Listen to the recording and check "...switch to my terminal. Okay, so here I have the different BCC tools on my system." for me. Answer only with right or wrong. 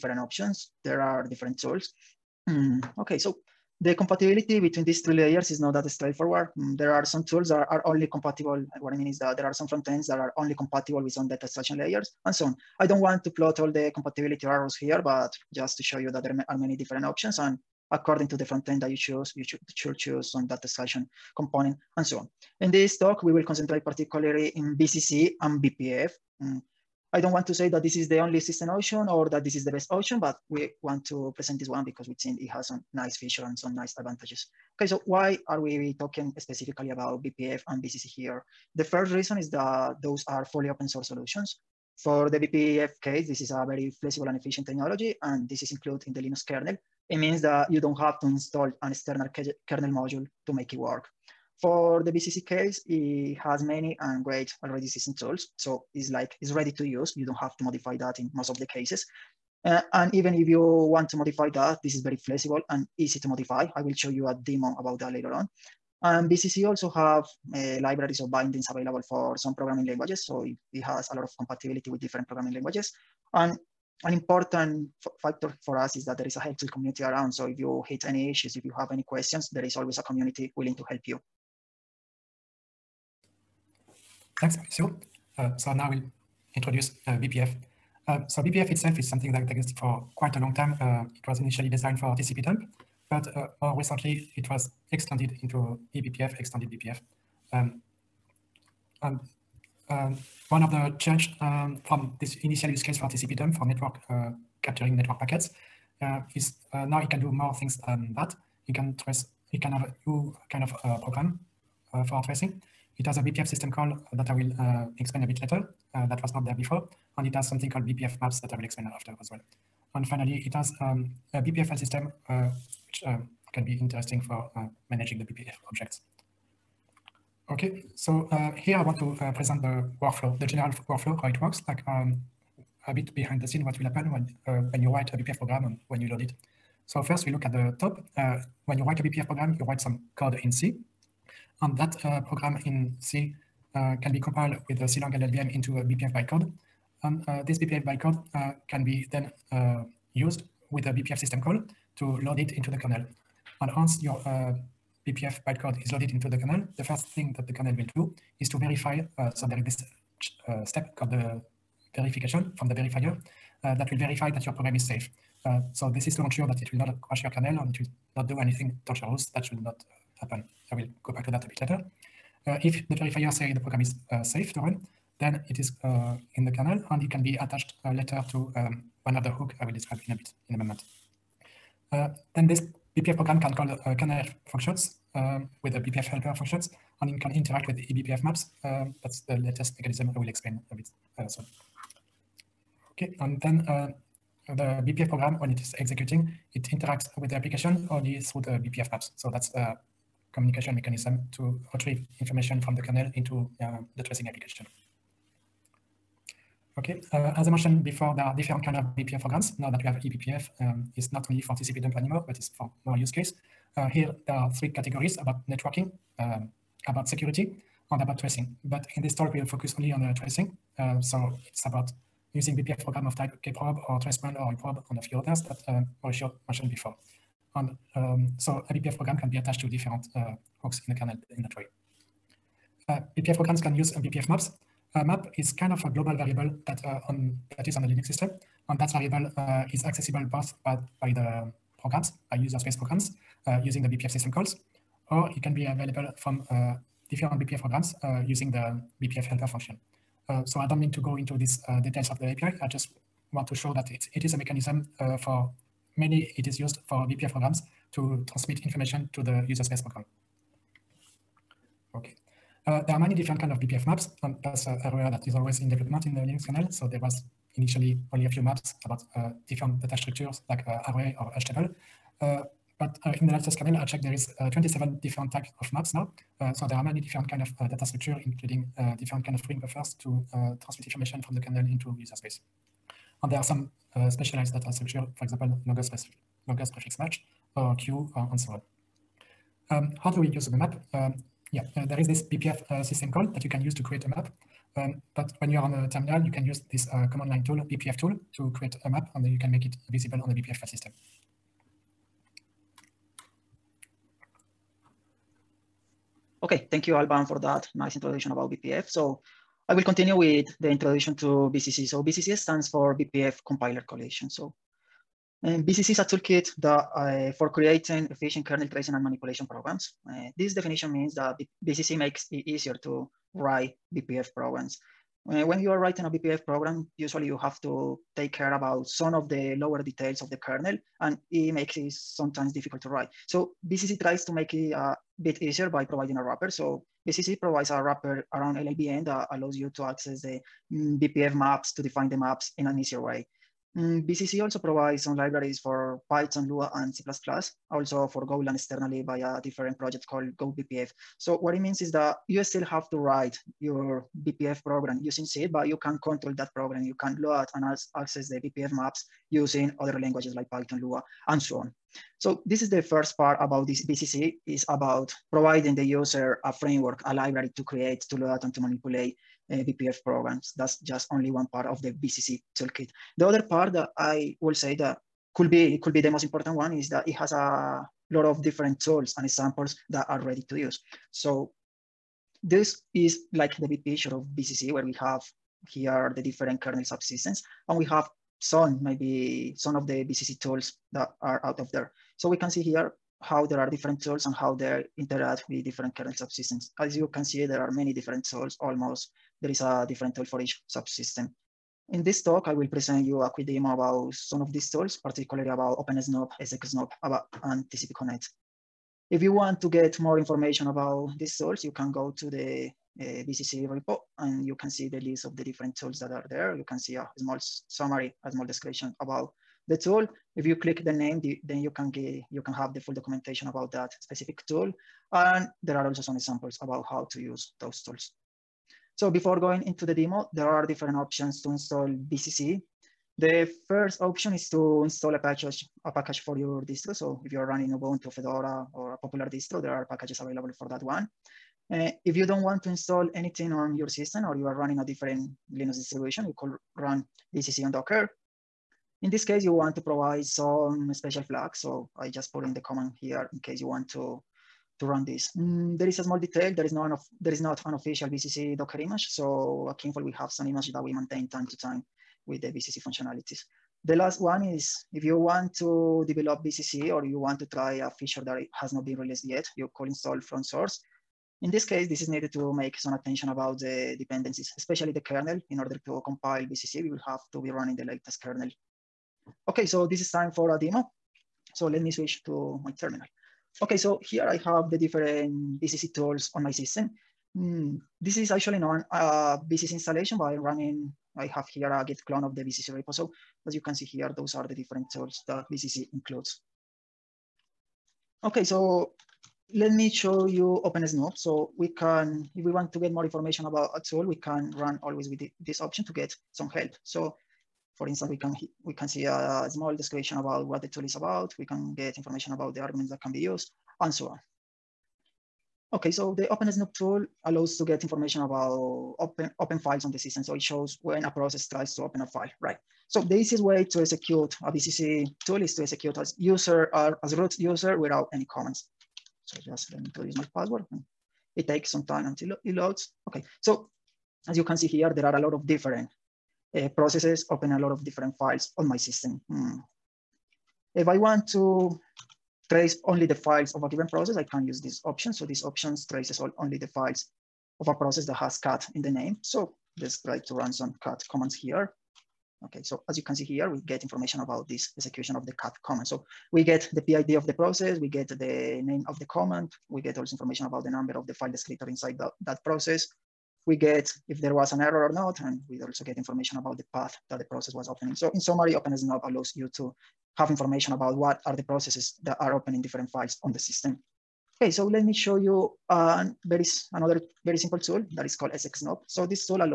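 right.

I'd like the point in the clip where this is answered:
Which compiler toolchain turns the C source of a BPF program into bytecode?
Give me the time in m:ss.
2:24.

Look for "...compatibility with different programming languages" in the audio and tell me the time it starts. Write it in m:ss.
1:11.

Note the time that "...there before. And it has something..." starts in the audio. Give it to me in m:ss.
1:56.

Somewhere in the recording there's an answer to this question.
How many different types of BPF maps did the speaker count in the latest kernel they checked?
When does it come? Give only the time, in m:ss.
4:34.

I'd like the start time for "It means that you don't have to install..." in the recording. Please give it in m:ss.
0:47.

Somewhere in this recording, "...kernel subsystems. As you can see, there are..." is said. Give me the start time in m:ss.
6:35.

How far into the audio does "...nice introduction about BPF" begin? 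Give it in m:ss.
5:07.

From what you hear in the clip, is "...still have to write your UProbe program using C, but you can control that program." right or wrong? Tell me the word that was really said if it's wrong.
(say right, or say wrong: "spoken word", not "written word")
wrong: "BPF", not "UProbe".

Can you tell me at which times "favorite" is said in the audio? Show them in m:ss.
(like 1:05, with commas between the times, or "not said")
not said.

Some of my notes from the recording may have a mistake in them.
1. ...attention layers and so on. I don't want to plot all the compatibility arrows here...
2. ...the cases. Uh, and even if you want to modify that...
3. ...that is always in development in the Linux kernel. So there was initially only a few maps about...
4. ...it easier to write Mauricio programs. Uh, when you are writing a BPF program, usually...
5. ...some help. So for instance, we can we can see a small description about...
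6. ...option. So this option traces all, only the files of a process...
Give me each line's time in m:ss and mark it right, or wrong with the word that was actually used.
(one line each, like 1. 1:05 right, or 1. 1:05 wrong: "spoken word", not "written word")
1. 0:11 wrong: "extraction", not "attention"
2. 0:58 right
3. 4:25 right
4. 5:22 wrong: "BPF", not "Mauricio"
5. 8:26 right
6. 9:04 right.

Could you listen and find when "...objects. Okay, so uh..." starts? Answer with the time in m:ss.
2:05.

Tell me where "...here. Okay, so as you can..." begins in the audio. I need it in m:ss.
9:11.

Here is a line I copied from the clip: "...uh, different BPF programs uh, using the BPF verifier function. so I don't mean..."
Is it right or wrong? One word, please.
wrong.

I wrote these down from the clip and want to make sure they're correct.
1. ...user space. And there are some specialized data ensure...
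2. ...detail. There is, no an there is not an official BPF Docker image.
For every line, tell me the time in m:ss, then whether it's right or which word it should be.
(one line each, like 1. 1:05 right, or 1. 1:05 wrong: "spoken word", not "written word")
1. 4:41 wrong: "structure", not "ensure"
2. 7:36 wrong: "BCC", not "BPF".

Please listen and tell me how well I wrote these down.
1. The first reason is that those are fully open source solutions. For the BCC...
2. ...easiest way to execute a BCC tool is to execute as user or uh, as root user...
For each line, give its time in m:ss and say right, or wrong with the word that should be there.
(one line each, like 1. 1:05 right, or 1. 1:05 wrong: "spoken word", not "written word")
1. 0:38 wrong: "BPF", not "BCC"
2. 8:43 right.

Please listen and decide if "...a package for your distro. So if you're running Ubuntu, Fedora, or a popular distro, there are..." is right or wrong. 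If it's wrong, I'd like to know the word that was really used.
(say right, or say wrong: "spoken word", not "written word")
right.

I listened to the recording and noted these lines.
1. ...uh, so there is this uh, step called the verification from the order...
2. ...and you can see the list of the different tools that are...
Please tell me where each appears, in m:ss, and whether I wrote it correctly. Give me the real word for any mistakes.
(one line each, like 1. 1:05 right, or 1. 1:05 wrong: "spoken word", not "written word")
1. 2:39 wrong: "verifier", not "order"
2. 6:54 right.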